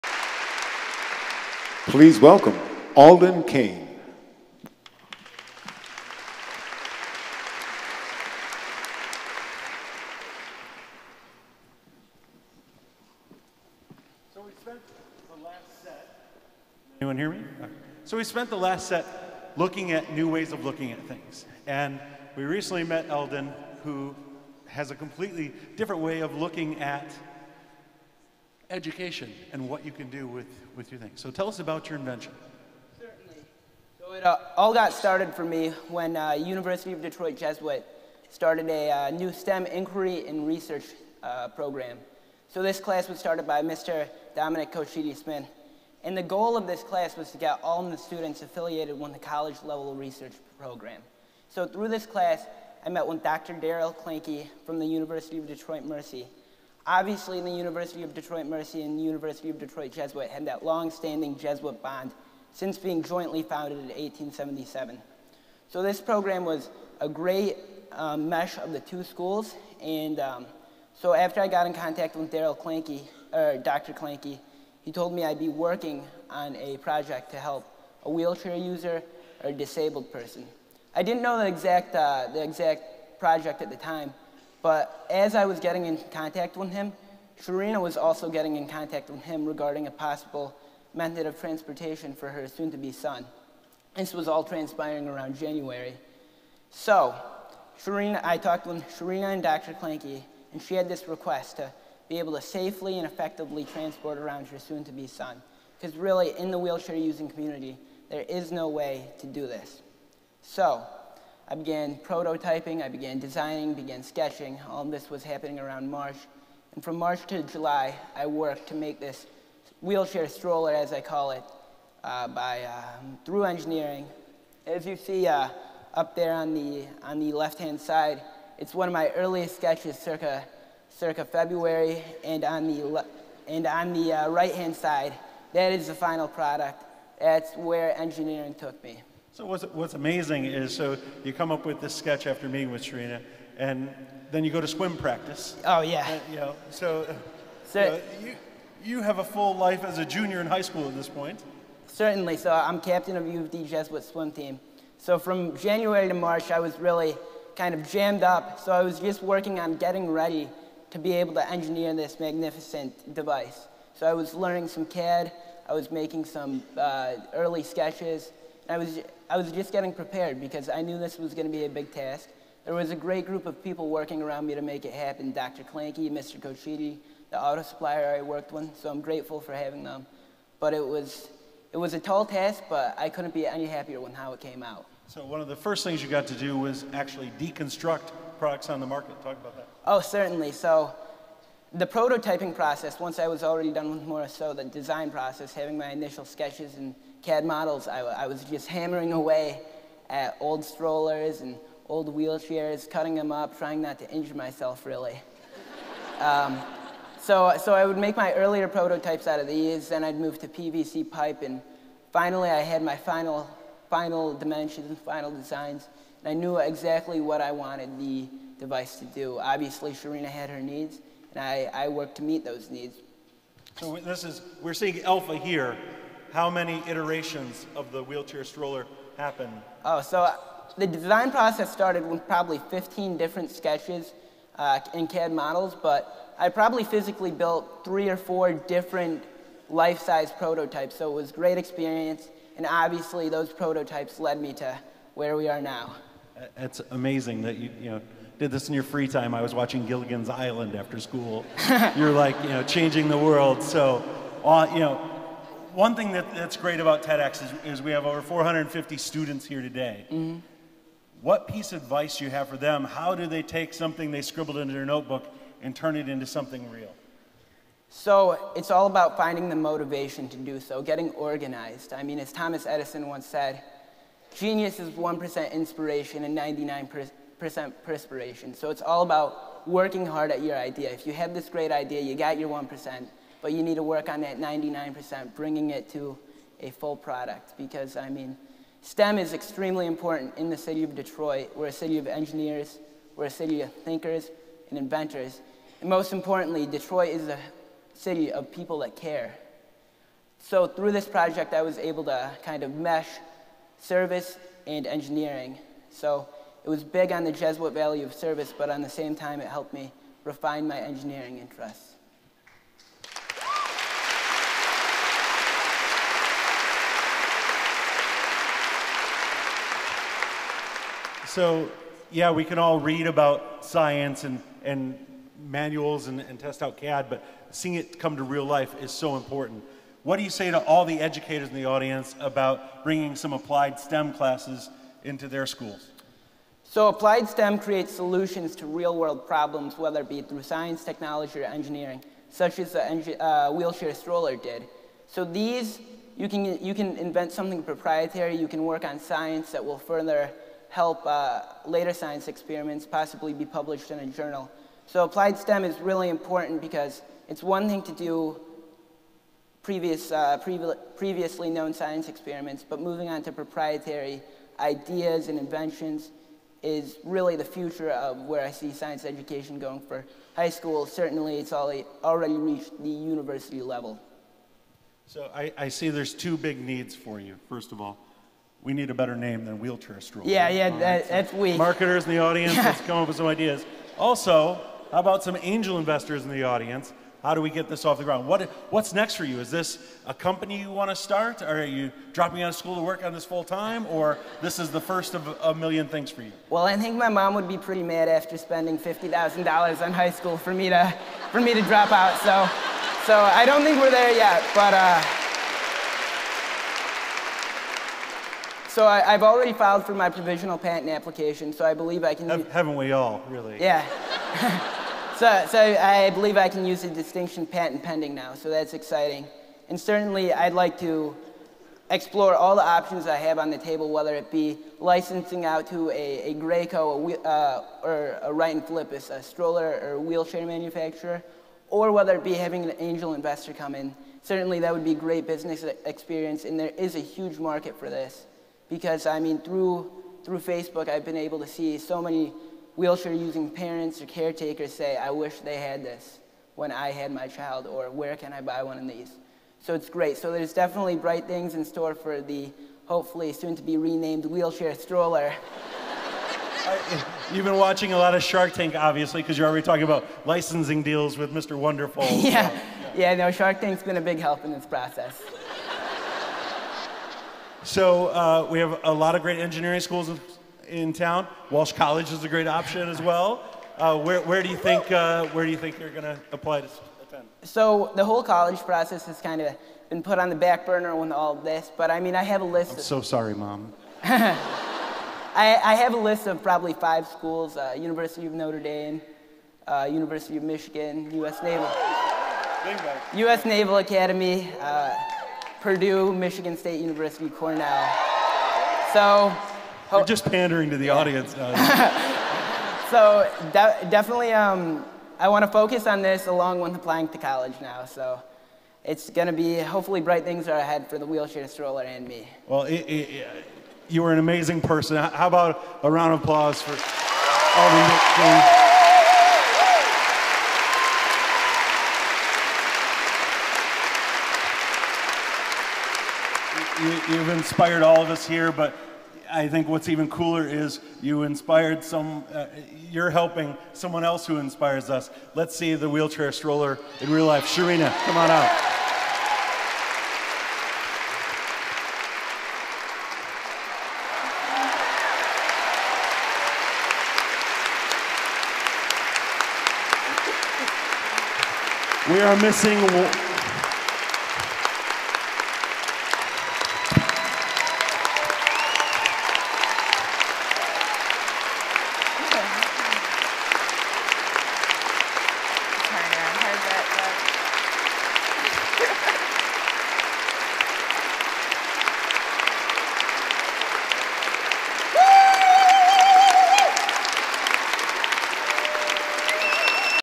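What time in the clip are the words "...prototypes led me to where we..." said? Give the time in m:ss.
4:03.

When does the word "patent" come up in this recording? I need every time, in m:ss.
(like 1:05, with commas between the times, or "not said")
6:50, 6:57.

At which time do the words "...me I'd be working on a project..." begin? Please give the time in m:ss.
1:15.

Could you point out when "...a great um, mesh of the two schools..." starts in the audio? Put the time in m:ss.
1:06.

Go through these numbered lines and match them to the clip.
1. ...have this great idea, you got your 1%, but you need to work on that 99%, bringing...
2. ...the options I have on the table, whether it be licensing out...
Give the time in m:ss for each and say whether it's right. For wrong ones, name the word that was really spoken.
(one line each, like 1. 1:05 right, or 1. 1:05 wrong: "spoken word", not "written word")
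1. 4:41 right
2. 7:02 right.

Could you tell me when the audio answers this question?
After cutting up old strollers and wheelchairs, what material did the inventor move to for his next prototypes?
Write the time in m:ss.
3:30.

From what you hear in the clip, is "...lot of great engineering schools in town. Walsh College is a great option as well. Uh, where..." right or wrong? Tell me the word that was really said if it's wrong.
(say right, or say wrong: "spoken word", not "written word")
right.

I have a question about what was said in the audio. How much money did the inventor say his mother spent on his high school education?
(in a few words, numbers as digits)
$50,000.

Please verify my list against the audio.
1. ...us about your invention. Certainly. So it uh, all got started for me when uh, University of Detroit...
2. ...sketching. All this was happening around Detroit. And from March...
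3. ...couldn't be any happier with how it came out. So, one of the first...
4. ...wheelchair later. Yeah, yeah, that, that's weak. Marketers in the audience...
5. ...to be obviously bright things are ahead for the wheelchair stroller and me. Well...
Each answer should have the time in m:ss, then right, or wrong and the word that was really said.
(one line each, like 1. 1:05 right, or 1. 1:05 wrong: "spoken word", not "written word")
1. 0:31 right
2. 1:54 wrong: "March", not "Detroit"
3. 3:03 right
4. 6:19 wrong: "stroller", not "later"
5. 8:29 wrong: "hopefully", not "obviously".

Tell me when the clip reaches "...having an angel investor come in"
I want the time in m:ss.
7:12.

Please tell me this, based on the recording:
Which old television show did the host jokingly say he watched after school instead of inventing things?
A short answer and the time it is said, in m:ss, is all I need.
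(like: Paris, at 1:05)
Gilligan's Island, at 4:09.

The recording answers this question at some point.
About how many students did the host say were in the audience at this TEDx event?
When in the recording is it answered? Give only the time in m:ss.
4:18.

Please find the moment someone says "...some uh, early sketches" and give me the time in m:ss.
2:46.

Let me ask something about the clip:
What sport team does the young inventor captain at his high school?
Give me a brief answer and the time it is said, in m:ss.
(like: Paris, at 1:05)
swim team, at 2:34.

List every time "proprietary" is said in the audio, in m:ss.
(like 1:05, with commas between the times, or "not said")
5:47, 6:03.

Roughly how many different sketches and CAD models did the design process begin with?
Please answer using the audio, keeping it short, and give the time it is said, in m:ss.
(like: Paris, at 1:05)
15, at 3:52.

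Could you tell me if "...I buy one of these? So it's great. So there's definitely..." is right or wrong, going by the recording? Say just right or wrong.
right.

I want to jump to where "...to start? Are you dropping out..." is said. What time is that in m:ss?
6:30.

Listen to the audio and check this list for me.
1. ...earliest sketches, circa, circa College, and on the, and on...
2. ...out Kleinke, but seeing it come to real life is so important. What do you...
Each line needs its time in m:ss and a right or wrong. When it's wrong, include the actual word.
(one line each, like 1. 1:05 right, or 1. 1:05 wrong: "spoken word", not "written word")
1. 2:09 wrong: "February", not "College"
2. 5:26 wrong: "CAD", not "Kleinke".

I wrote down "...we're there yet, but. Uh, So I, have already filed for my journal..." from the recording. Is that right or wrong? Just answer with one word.
wrong.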